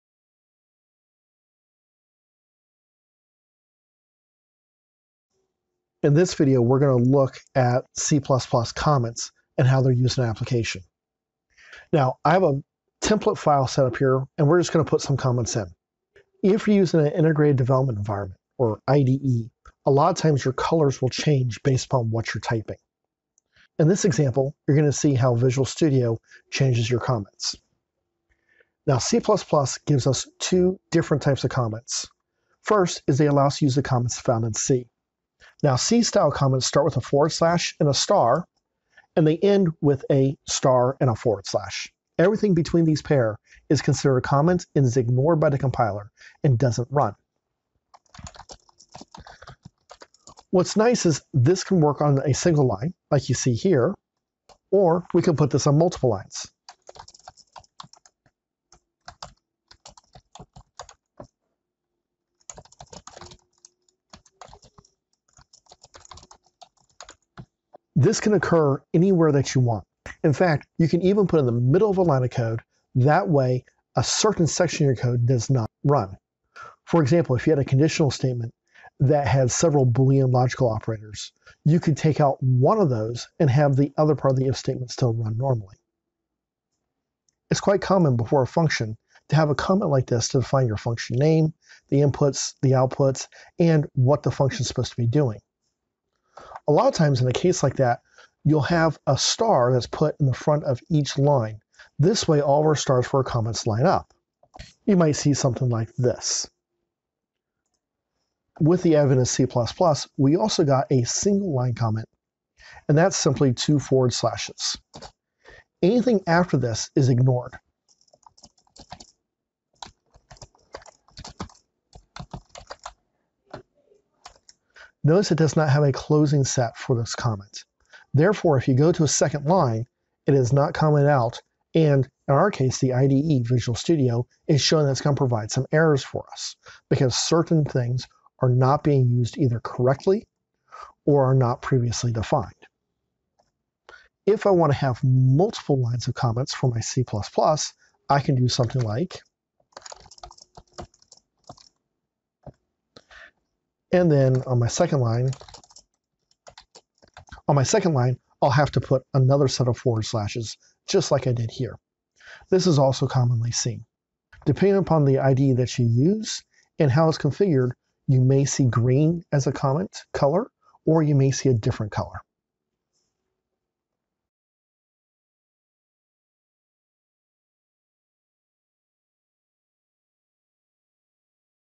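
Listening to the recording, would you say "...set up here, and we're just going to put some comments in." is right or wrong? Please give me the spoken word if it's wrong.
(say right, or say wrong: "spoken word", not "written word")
right.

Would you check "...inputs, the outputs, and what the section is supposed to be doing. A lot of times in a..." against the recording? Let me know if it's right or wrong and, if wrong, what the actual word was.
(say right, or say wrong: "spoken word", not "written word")
wrong: "function", not "section".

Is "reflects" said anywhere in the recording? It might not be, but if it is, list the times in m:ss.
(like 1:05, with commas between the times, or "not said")
not said.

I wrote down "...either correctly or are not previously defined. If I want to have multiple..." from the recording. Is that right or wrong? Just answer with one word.
right.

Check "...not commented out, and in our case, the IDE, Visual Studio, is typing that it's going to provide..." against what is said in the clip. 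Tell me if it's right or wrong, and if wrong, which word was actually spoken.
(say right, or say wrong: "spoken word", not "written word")
wrong: "showing", not "typing".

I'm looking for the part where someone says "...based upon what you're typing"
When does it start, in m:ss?
0:21.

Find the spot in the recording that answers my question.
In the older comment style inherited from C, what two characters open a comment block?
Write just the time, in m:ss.
0:36.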